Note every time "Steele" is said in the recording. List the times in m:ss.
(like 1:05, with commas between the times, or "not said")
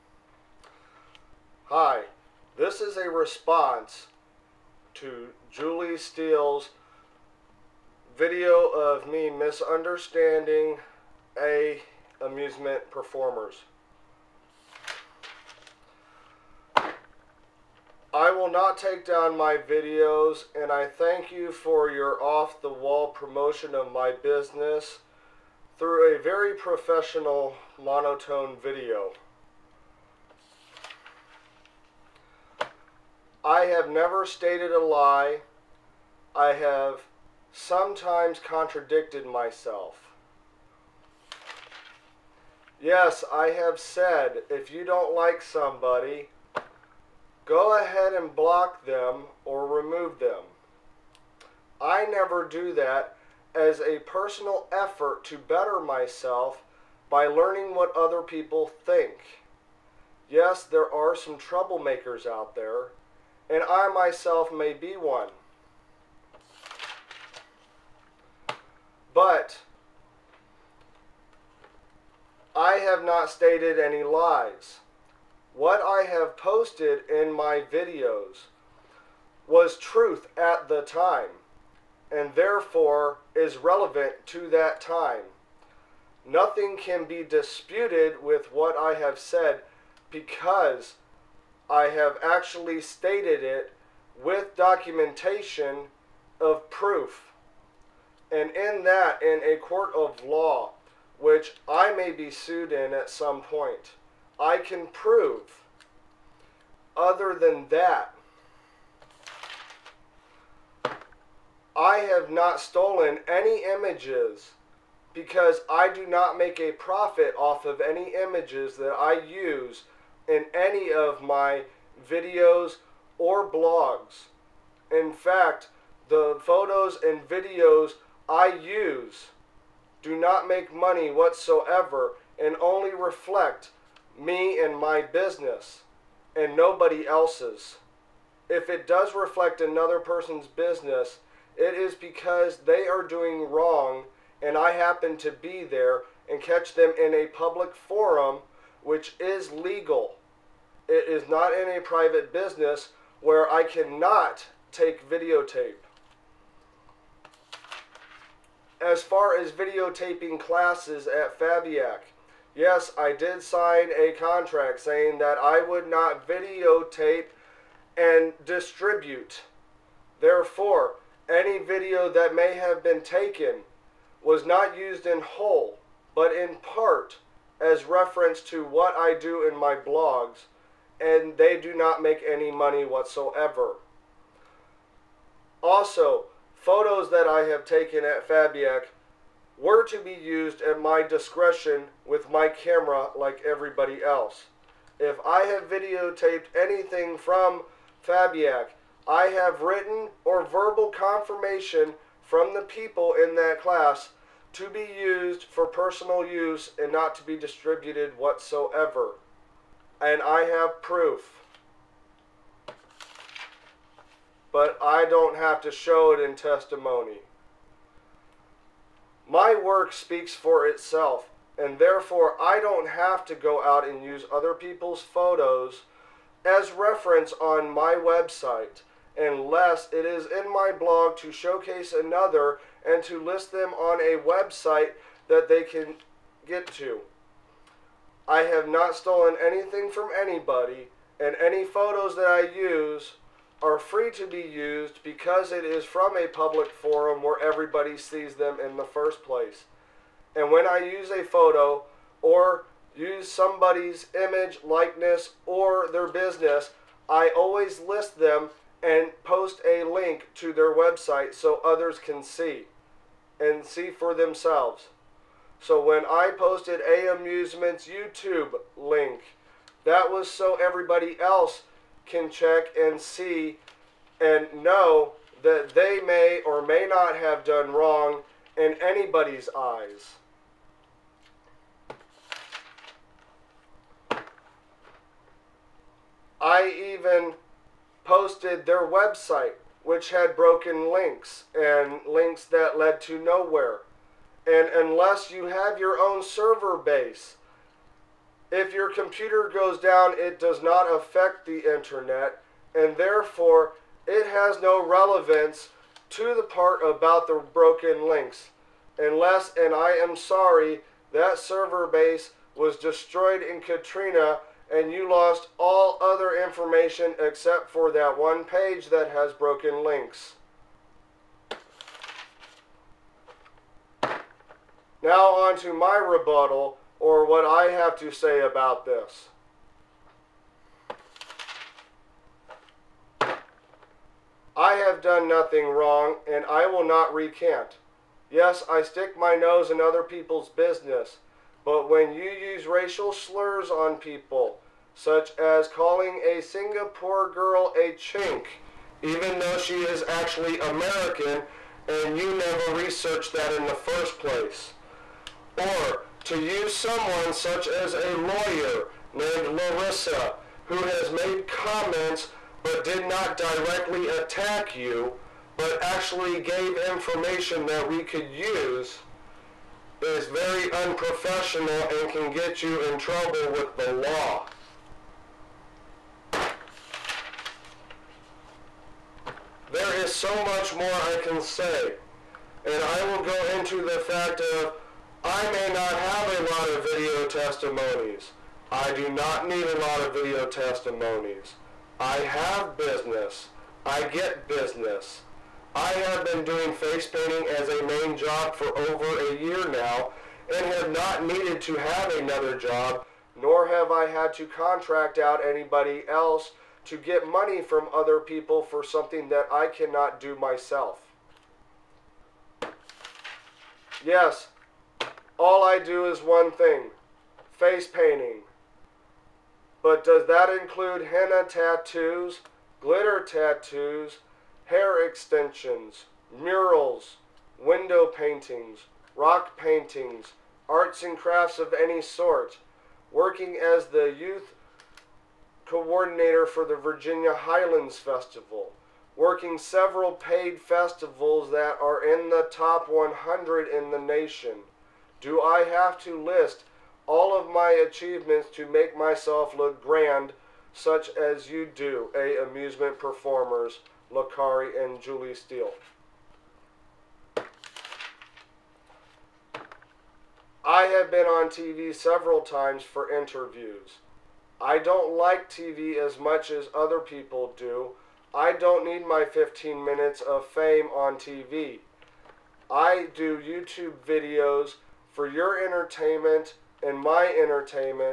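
0:05, 7:35.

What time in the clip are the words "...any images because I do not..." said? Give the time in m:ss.
1:53.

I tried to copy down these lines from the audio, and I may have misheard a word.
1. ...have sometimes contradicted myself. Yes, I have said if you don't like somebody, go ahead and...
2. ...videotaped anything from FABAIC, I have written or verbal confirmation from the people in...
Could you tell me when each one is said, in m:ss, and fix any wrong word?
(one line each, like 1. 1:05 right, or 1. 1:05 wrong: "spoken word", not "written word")
1. 0:36 right
2. 3:15 right.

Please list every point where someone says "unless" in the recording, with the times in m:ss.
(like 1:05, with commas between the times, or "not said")
3:49, 4:54, 5:08.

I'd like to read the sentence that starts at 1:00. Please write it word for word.
Yes, there are some troublemakers out there, and I myself may be one.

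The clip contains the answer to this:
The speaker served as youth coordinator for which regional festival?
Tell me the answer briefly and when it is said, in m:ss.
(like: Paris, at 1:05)
Virginia Highlands Festival, at 7:16.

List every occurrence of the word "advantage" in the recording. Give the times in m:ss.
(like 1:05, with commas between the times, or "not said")
not said.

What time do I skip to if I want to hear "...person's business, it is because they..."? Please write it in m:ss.
2:19.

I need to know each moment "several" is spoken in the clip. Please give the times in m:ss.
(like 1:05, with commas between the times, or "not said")
7:19, 7:41.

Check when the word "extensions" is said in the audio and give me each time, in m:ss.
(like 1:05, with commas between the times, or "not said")
7:05.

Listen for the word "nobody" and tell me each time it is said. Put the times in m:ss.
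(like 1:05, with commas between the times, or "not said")
2:16.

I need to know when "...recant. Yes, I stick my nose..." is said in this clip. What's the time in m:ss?
5:37.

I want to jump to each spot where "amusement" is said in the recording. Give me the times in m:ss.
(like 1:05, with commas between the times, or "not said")
0:12, 4:27, 7:32.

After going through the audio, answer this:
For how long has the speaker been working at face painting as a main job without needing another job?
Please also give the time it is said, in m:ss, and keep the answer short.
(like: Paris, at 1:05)
over a year, at 6:38.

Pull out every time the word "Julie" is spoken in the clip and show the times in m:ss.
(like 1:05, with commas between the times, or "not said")
0:05, 7:35.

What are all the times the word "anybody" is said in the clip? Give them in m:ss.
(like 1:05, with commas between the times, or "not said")
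4:00, 4:38, 6:45.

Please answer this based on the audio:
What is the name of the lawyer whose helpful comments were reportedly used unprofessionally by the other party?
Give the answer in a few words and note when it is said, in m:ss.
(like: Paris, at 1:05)
Larissa, at 5:59.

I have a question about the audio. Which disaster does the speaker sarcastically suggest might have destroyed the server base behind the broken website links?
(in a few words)
Katrina.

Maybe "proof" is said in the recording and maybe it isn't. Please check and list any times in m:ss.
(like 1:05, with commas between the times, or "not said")
1:36, 3:30.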